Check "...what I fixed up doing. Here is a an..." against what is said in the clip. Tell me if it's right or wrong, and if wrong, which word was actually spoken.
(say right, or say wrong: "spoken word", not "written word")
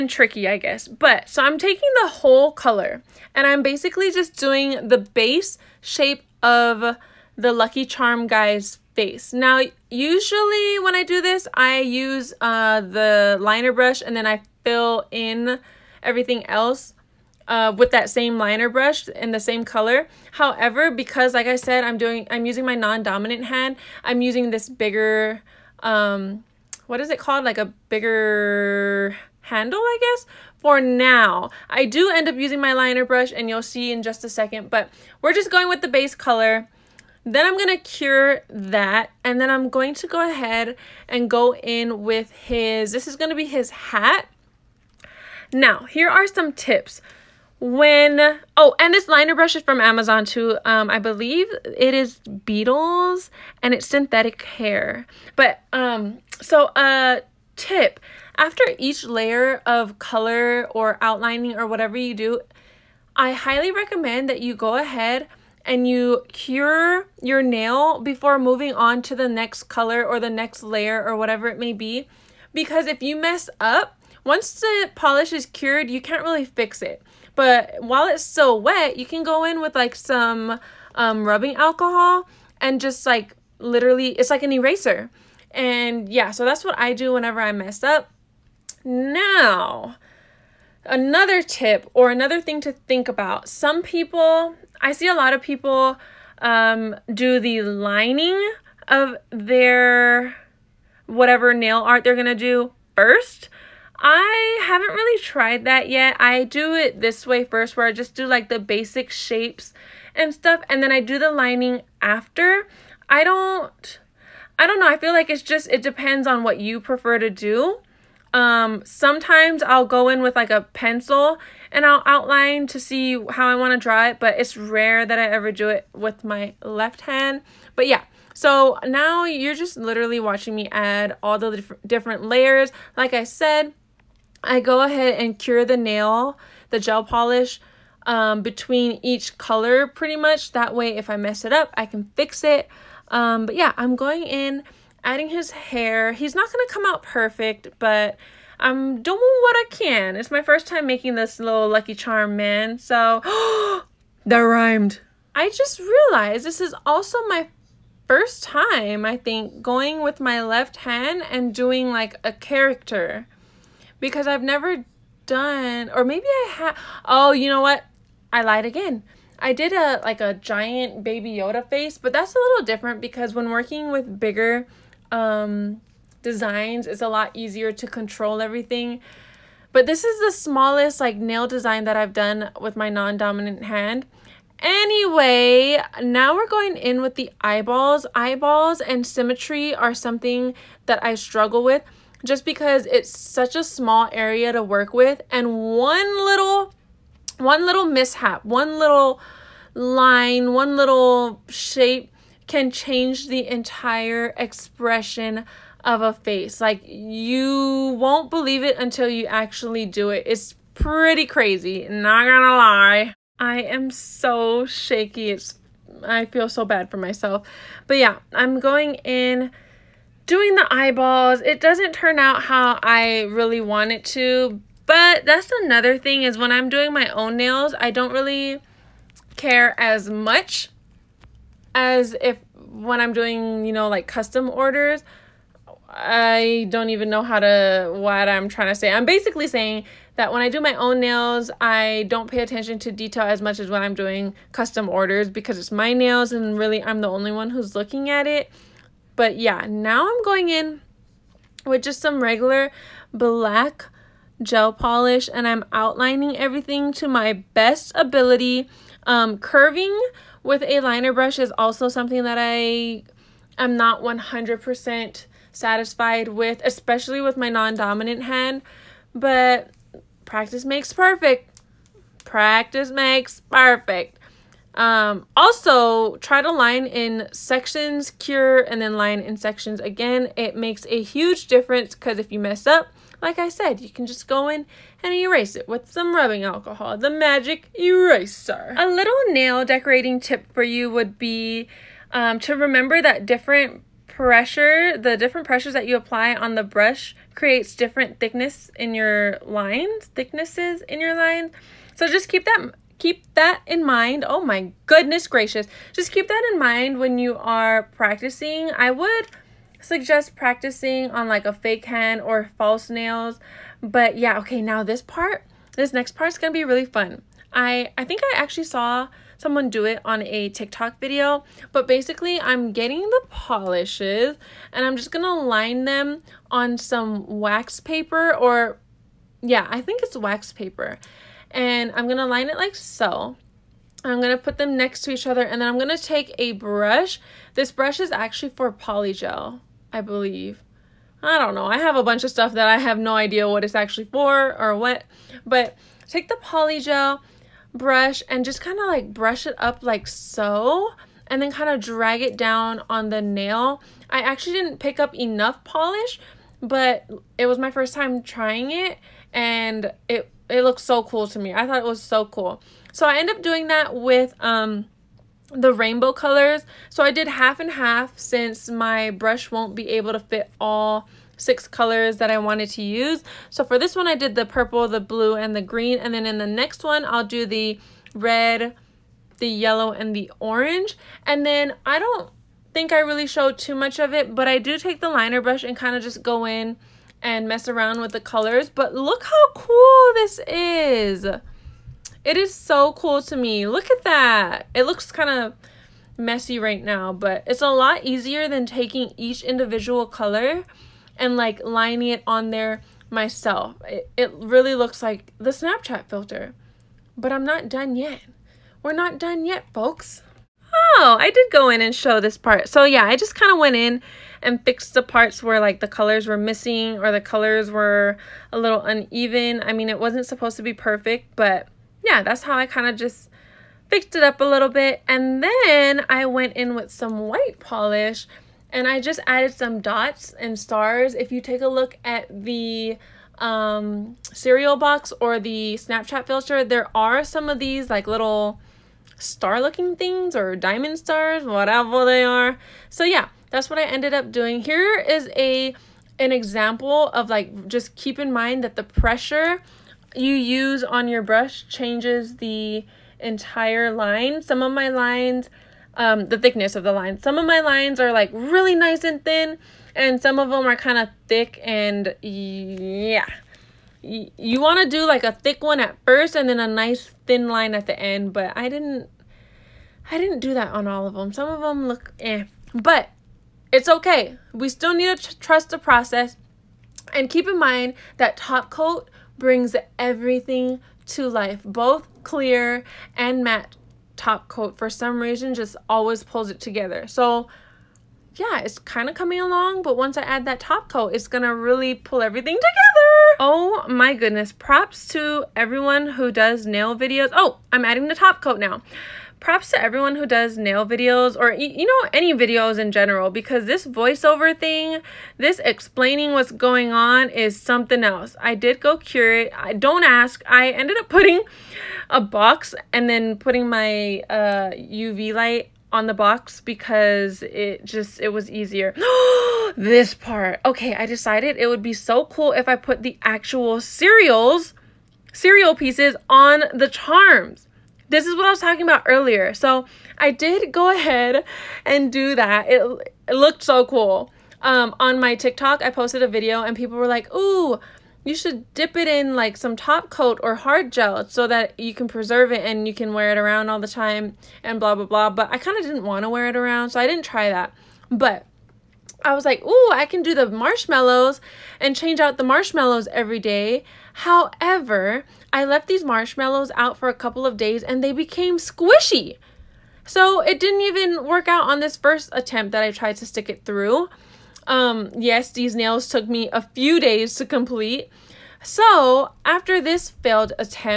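wrong: "ended", not "fixed".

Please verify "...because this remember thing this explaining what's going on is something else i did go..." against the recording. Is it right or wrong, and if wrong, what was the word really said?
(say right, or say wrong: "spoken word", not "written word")
wrong: "voiceover", not "remember".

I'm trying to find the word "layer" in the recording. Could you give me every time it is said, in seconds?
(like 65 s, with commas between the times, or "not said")
59 s, 70 s, 132 s.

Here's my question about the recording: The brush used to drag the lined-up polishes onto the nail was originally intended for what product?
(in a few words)
polygel.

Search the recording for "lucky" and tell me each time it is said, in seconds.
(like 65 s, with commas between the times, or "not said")
7 s, 151 s.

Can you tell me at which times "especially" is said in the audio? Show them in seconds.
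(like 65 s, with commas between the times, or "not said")
266 s.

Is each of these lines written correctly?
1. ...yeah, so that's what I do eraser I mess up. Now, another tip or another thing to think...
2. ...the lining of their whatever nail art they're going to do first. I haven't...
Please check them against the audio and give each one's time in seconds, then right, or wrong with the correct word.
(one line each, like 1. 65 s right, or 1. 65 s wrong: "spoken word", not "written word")
1. 86 s wrong: "whenever", not "eraser"
2. 97 s right.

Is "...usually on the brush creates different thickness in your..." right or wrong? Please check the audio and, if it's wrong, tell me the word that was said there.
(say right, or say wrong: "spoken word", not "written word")
wrong: "apply", not "usually".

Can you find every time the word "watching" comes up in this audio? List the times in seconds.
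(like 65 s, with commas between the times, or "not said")
130 s.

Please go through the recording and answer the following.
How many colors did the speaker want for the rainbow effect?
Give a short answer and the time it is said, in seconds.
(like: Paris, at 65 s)
6, at 371 s.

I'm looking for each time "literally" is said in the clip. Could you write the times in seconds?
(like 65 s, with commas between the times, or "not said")
83 s, 129 s.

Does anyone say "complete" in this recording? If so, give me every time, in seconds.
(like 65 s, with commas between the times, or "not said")
567 s.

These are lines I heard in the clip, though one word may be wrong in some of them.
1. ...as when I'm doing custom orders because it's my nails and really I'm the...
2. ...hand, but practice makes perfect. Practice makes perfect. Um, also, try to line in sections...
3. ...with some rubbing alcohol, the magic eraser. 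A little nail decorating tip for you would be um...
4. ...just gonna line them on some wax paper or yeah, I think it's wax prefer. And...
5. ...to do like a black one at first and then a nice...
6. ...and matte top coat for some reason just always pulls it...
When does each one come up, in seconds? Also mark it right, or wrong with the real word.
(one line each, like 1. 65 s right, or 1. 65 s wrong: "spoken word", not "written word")
1. 243 s right
2. 268 s right
3. 285 s right
4. 324 s wrong: "paper", not "prefer"
5. 464 s wrong: "thick", not "black"
6. 483 s right.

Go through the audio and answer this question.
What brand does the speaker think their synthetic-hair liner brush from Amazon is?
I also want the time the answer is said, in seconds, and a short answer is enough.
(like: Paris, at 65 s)
Beetles, at 52 s.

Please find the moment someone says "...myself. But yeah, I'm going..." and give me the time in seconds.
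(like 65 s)
216 s.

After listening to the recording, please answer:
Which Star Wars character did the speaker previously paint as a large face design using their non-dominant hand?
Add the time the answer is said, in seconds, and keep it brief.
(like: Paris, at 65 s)
baby Yoda, at 171 s.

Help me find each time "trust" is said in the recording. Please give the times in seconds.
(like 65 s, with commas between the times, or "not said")
475 s.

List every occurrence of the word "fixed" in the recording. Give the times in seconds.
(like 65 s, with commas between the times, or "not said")
414 s, 423 s.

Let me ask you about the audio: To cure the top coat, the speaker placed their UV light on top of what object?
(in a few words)
a box.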